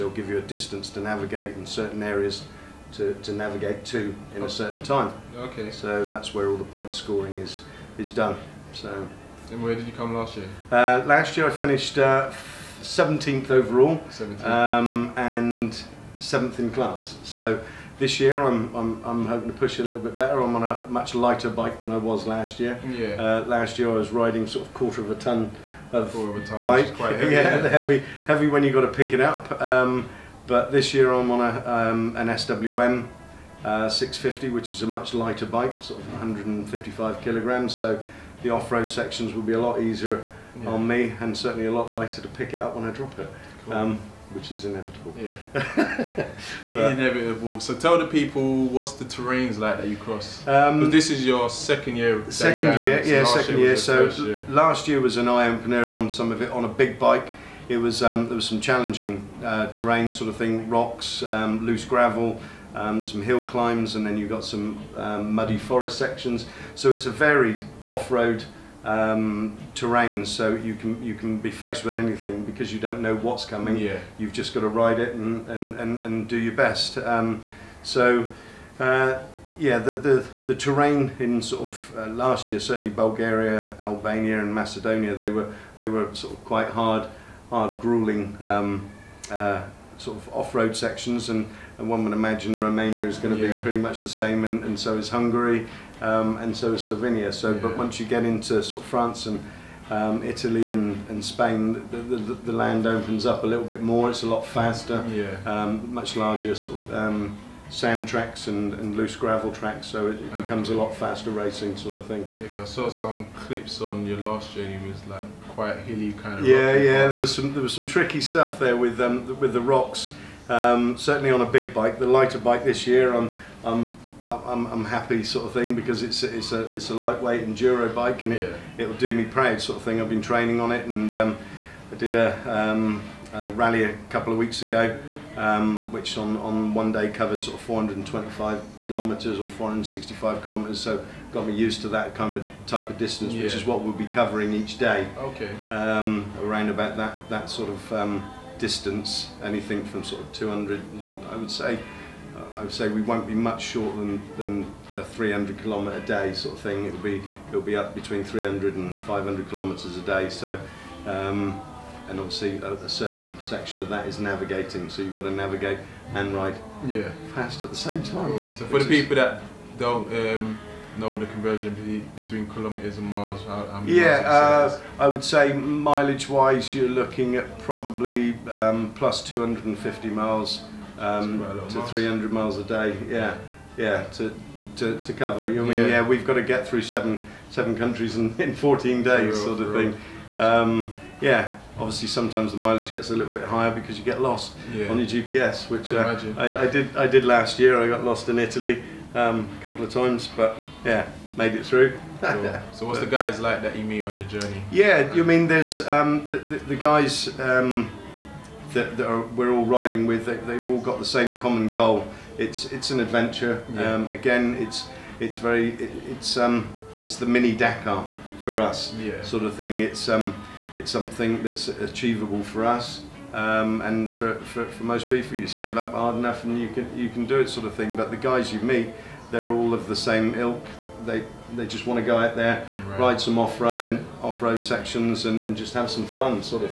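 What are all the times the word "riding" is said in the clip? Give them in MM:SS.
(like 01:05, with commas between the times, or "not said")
00:24, 03:29.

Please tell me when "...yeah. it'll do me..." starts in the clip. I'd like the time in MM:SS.
02:08.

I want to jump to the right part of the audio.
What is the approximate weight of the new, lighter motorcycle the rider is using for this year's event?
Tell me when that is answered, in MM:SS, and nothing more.
00:36.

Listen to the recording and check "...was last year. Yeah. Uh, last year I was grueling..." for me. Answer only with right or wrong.
wrong.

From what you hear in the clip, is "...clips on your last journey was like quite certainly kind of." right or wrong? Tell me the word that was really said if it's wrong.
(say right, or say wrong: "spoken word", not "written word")
wrong: "hilly", not "certainly".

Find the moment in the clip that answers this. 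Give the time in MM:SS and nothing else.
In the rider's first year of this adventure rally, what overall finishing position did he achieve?
00:12.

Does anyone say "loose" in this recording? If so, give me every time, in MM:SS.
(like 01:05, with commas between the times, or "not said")
01:01, 01:48.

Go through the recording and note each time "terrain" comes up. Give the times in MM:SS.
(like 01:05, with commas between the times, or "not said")
00:49, 00:59, 01:09, 01:20.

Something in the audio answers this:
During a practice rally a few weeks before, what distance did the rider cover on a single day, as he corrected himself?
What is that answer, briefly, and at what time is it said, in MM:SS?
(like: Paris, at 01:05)
465 kilometres, at 02:19.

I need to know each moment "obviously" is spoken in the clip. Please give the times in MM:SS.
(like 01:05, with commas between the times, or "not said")
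02:42, 03:11.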